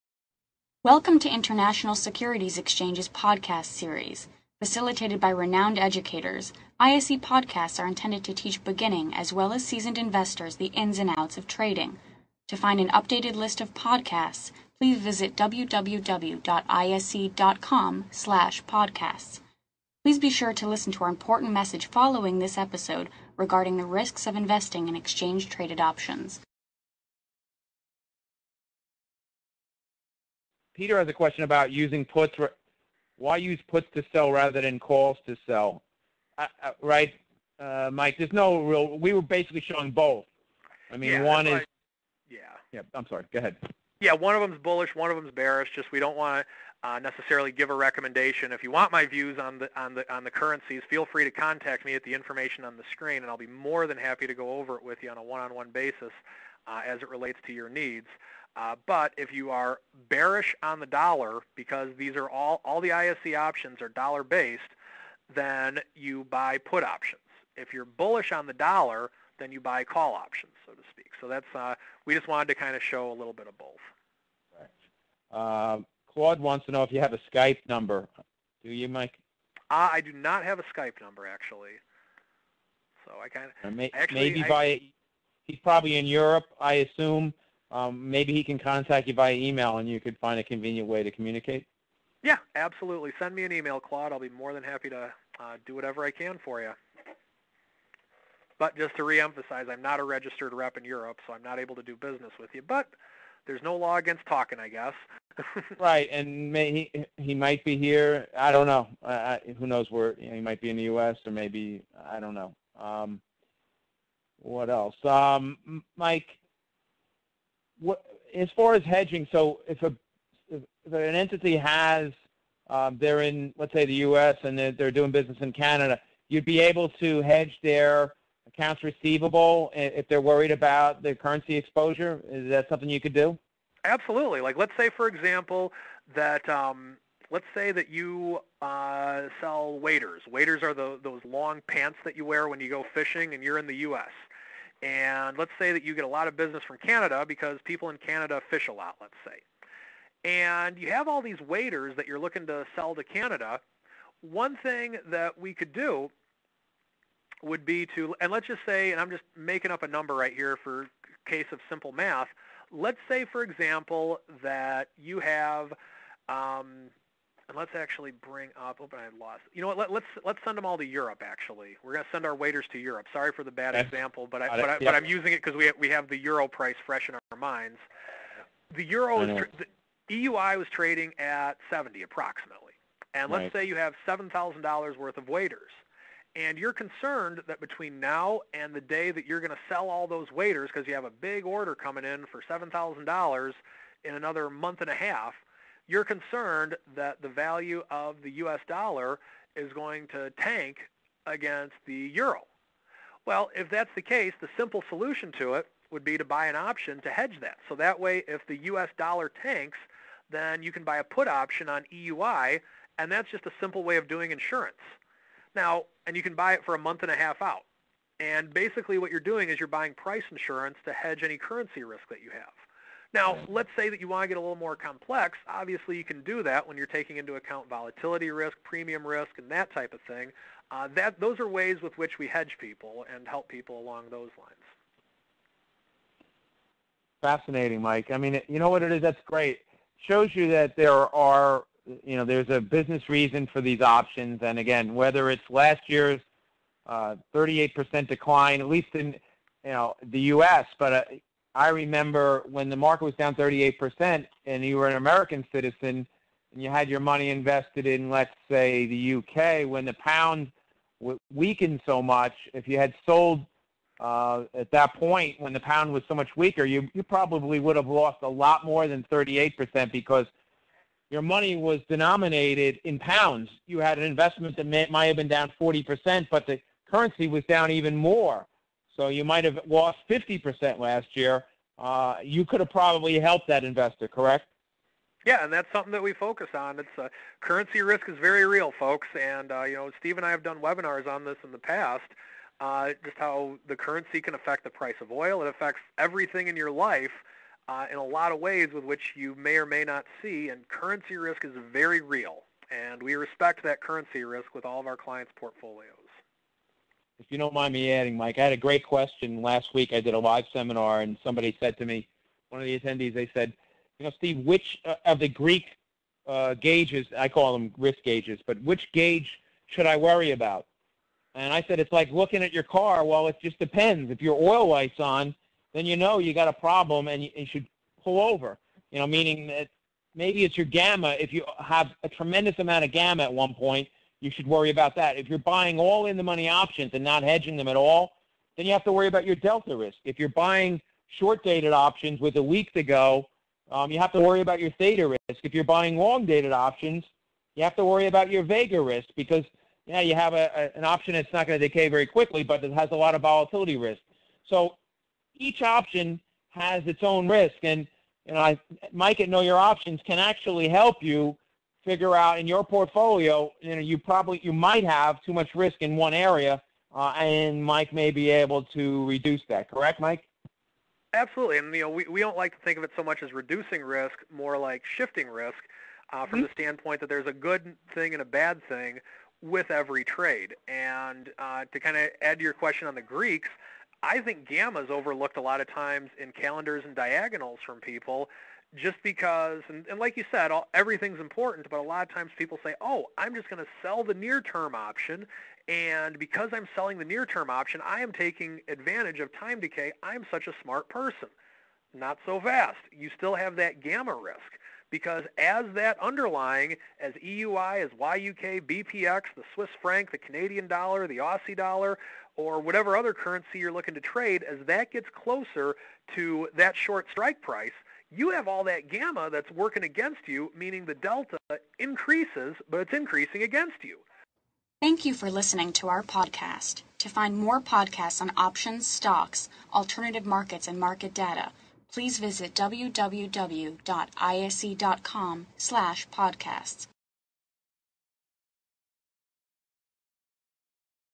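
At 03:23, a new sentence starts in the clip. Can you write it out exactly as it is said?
Well, if that's the case, the simple solution to it would be to buy an option to hedge that.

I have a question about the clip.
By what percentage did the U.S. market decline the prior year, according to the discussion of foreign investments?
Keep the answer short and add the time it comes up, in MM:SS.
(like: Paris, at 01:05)
38%, at 04:07.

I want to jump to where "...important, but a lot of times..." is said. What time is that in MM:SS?
06:31.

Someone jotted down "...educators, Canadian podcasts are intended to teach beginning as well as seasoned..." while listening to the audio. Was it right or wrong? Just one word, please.
wrong.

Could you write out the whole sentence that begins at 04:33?
You had an investment that may, might have been down 40%, but the currency was down even more.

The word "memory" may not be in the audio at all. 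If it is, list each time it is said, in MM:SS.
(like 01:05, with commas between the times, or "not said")
not said.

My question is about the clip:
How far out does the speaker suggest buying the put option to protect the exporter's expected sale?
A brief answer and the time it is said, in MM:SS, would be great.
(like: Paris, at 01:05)
A month and a half, at 03:36.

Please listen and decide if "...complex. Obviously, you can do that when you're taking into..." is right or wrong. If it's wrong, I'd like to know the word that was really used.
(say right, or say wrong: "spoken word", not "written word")
right.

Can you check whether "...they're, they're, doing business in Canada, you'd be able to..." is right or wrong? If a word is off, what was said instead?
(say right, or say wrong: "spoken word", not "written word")
right.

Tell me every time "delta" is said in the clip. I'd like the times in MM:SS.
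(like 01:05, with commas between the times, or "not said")
05:39, 07:00.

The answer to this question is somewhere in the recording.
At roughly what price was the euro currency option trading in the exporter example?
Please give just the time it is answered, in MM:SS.
03:01.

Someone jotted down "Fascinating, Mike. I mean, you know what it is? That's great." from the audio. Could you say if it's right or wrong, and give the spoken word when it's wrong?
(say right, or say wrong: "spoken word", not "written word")
right.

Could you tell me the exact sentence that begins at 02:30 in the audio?
And you have all these waders that you're looking to sell to Canada.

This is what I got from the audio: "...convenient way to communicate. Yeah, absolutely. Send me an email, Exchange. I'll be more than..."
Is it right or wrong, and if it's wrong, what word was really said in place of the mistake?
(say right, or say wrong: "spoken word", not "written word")
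wrong: "Claude", not "Exchange".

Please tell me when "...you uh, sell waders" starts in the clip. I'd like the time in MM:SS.
02:17.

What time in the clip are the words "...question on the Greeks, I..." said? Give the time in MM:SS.
06:22.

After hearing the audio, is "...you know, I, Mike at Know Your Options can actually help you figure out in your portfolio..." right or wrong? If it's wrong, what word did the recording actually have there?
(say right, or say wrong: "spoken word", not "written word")
right.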